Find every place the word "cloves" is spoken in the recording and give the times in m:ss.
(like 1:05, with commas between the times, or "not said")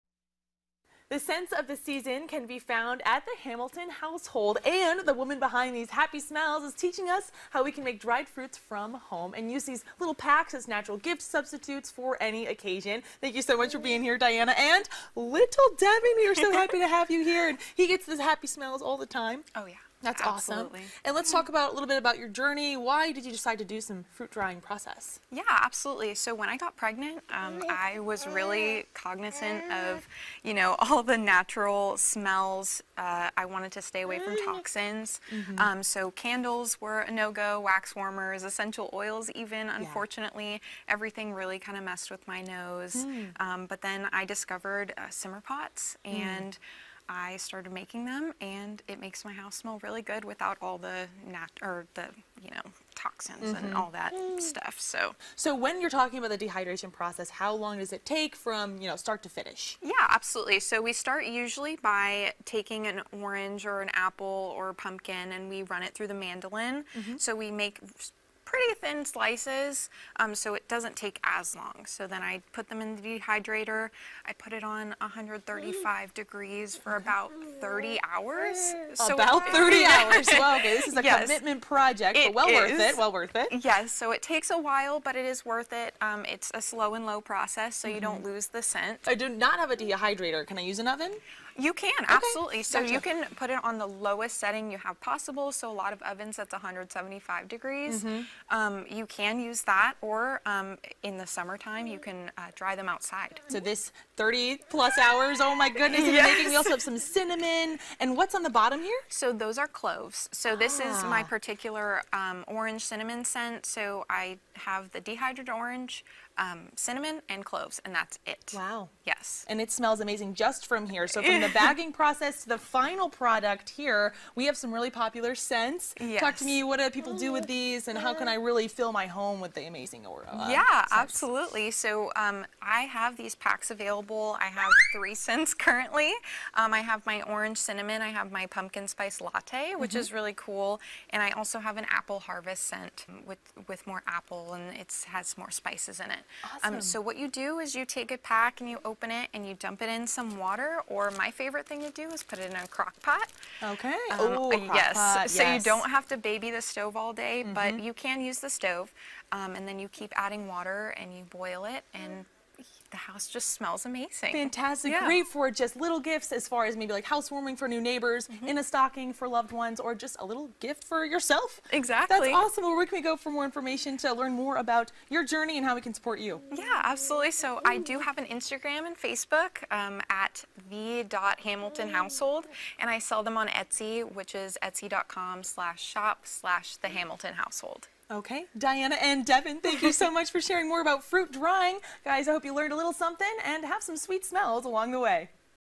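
1:49, 1:57.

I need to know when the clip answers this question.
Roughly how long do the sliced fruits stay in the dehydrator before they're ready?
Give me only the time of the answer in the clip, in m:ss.
1:17.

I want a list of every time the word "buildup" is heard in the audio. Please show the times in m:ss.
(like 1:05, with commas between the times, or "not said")
not said.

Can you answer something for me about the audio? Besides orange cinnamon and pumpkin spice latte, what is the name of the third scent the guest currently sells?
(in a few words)
Apple harvest.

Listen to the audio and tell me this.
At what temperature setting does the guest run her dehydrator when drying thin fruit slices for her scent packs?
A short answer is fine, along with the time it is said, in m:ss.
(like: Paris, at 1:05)
135 degrees, at 1:14.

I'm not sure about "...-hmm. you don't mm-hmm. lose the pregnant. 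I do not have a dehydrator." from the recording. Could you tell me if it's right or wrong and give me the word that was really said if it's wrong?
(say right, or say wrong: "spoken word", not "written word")
wrong: "scent", not "pregnant".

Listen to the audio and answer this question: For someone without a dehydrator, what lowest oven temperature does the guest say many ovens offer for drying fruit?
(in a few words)
175 degrees.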